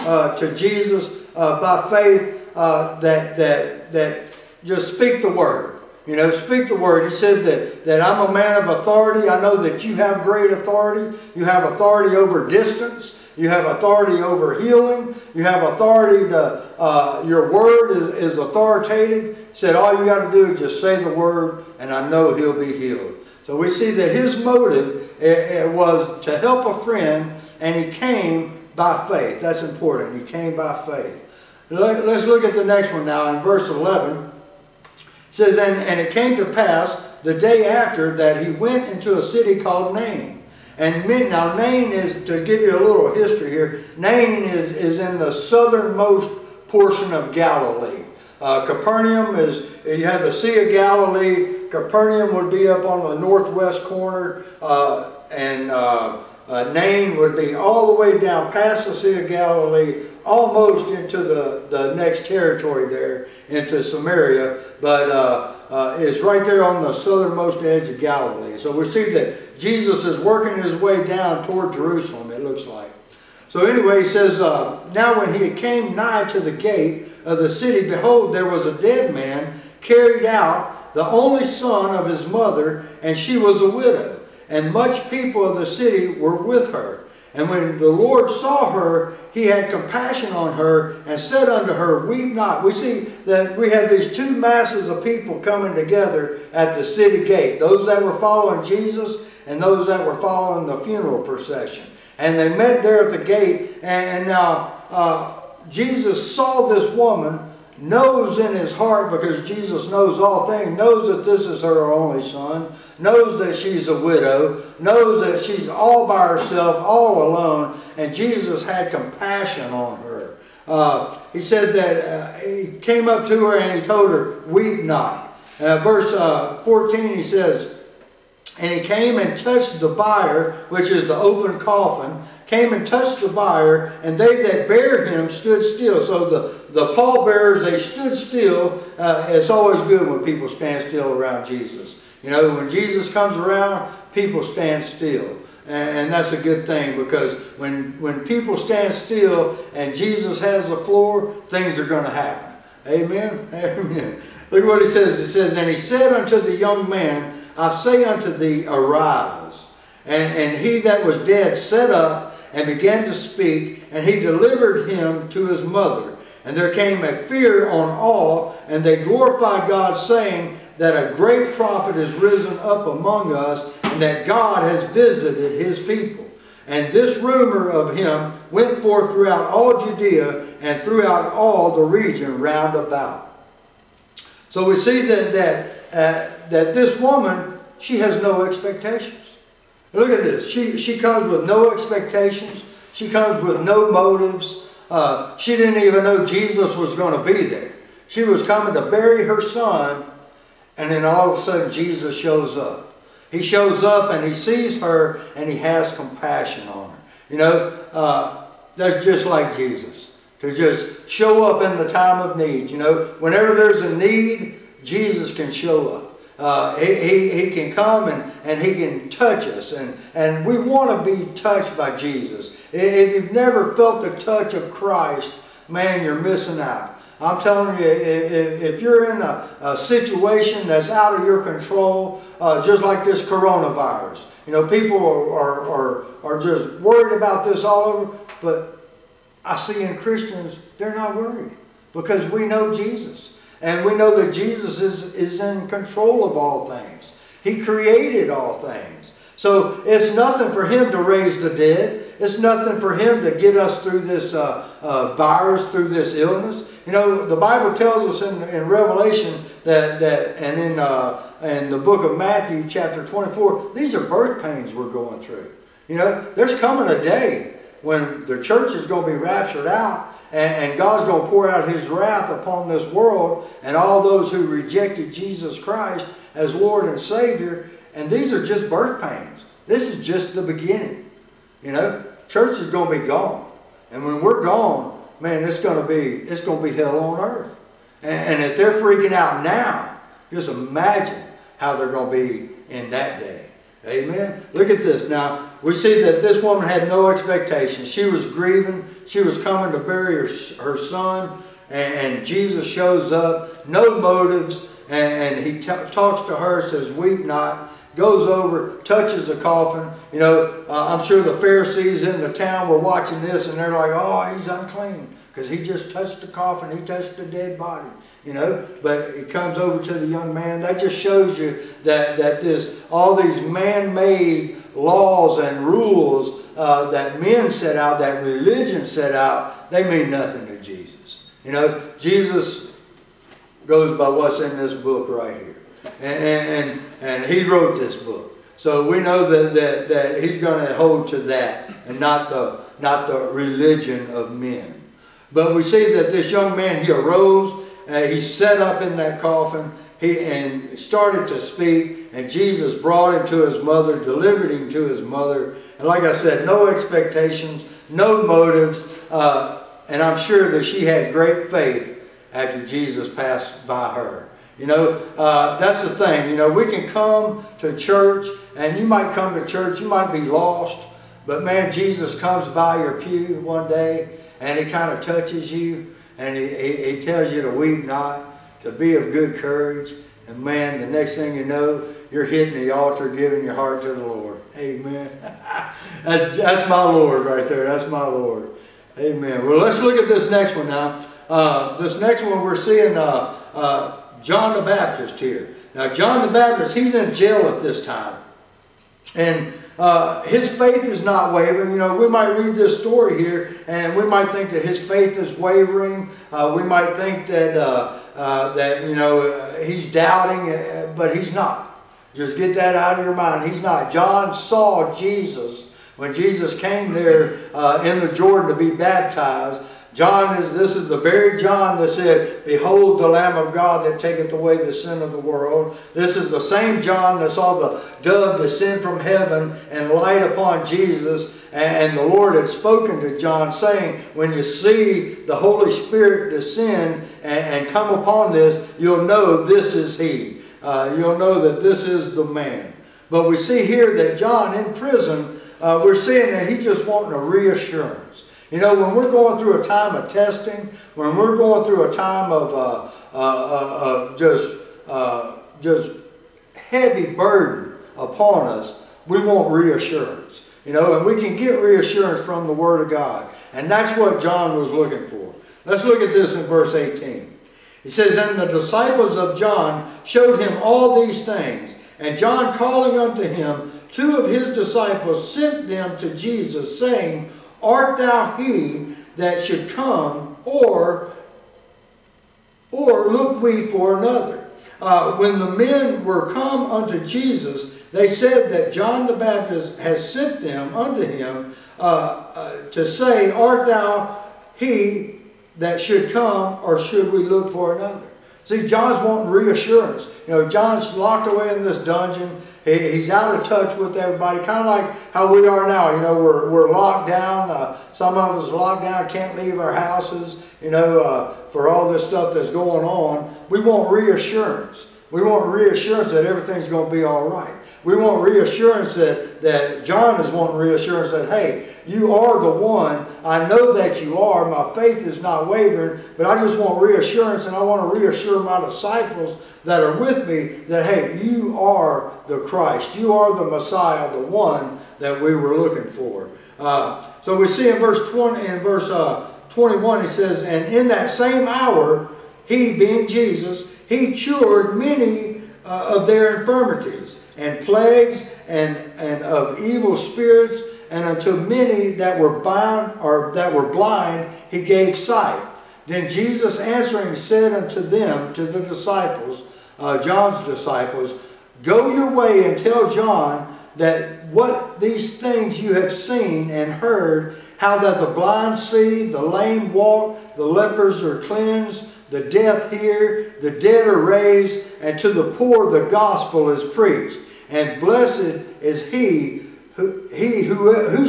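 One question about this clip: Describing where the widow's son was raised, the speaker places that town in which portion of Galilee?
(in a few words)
southernmost portion.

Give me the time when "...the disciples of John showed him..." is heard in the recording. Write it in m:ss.
7:48.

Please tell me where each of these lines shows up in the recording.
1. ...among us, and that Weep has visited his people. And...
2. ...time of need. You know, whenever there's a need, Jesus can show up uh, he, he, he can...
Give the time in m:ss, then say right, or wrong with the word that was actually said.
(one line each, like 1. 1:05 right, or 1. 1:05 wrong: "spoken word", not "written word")
1. 2:52 wrong: "God", not "Weep"
2. 3:31 right.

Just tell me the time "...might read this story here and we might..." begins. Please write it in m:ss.
6:42.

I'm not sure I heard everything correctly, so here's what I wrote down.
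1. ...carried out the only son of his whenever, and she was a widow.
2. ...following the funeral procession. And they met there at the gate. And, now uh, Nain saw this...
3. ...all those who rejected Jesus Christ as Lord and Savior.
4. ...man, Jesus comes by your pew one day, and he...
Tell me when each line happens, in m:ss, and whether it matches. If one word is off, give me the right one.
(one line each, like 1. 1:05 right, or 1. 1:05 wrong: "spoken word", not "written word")
1. 1:19 wrong: "mother", not "whenever"
2. 1:40 wrong: "Jesus", not "Nain"
3. 4:33 right
4. 6:11 right.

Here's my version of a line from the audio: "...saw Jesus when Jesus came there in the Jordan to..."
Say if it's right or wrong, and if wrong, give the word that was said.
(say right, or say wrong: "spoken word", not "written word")
right.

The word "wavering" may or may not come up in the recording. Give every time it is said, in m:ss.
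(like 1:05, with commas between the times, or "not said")
6:41, 6:45, 8:45.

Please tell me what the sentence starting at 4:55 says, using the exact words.
Now, we see that this woman had no expectation.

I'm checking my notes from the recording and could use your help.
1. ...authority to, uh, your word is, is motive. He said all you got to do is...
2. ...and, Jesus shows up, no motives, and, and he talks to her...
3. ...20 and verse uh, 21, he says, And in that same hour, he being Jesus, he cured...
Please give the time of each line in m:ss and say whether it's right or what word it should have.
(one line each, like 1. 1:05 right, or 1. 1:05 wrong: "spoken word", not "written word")
1. 0:15 wrong: "authoritative", not "motive"
2. 5:01 right
3. 8:58 right.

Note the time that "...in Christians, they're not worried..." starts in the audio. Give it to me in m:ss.
3:59.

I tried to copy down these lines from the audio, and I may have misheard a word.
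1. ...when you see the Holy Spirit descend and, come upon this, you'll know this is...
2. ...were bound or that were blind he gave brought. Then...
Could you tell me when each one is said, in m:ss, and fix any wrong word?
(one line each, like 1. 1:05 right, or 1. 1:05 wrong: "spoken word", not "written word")
1. 7:14 right
2. 9:12 wrong: "sight", not "brought".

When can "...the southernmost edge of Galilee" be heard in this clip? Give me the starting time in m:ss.
1:06.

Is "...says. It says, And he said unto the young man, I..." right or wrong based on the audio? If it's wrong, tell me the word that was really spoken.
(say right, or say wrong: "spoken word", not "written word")
right.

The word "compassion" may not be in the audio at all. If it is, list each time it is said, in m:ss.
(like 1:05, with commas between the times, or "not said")
1:29, 1:58, 3:25.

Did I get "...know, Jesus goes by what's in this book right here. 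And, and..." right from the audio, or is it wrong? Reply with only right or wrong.
right.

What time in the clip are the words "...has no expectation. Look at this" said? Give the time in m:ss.
3:07.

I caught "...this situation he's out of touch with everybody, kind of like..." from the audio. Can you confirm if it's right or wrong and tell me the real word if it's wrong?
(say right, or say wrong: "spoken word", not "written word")
wrong: "dungeon", not "situation".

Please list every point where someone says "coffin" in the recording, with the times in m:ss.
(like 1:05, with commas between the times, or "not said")
2:11, 5:09, 5:16, 5:49.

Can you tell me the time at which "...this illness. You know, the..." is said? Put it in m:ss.
4:15.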